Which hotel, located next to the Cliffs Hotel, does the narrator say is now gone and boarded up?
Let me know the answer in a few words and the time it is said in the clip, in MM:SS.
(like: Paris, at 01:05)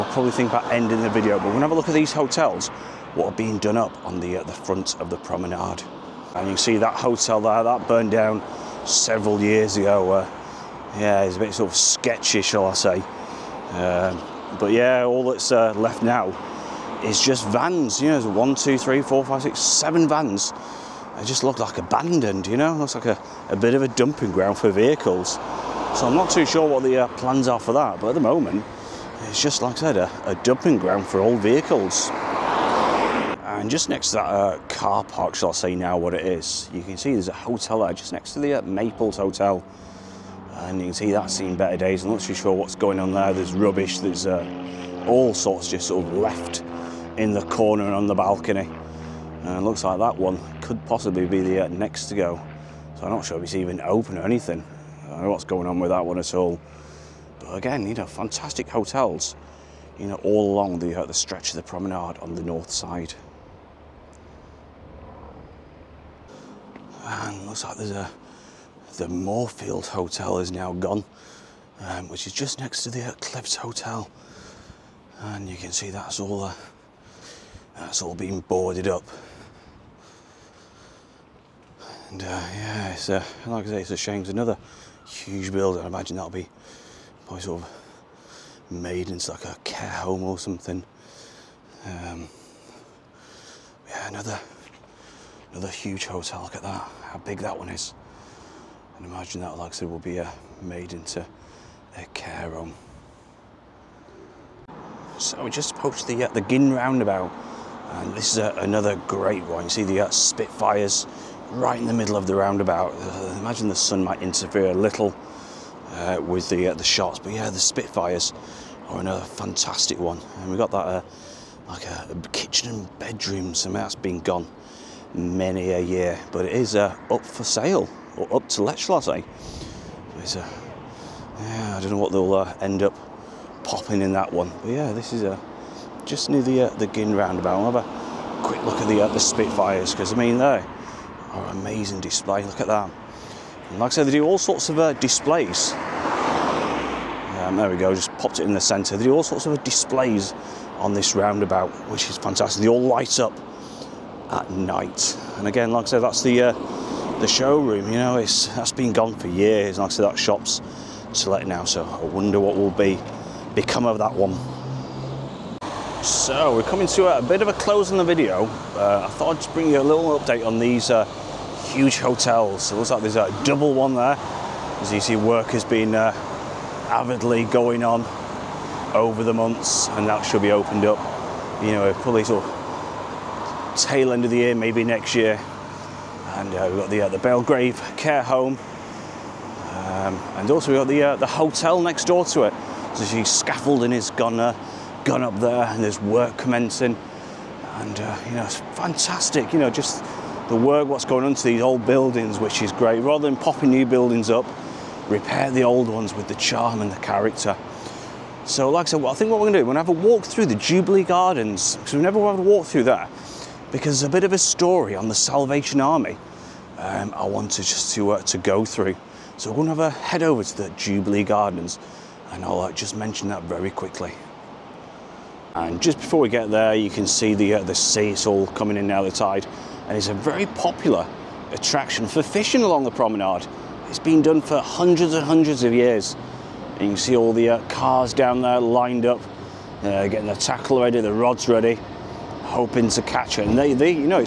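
Moorfield Hotel, at 01:09.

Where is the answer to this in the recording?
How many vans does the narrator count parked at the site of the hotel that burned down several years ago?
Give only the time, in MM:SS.
00:19.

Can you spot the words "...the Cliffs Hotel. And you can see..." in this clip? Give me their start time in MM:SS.
01:12.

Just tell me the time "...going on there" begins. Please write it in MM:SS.
00:42.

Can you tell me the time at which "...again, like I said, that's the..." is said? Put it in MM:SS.
02:35.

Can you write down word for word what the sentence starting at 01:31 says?
Um, yeah, another another huge hotel.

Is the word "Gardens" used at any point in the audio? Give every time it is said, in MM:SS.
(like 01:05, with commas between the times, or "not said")
03:31, 03:41.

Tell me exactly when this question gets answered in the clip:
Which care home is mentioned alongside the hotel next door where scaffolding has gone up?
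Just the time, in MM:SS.
03:07.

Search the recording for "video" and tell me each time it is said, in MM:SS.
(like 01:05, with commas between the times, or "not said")
00:01, 02:48.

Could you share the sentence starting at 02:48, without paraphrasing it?
Uh, I thought I'd just bring you a little update on these uh, huge hotels.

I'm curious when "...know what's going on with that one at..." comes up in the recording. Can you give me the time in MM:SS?
00:55.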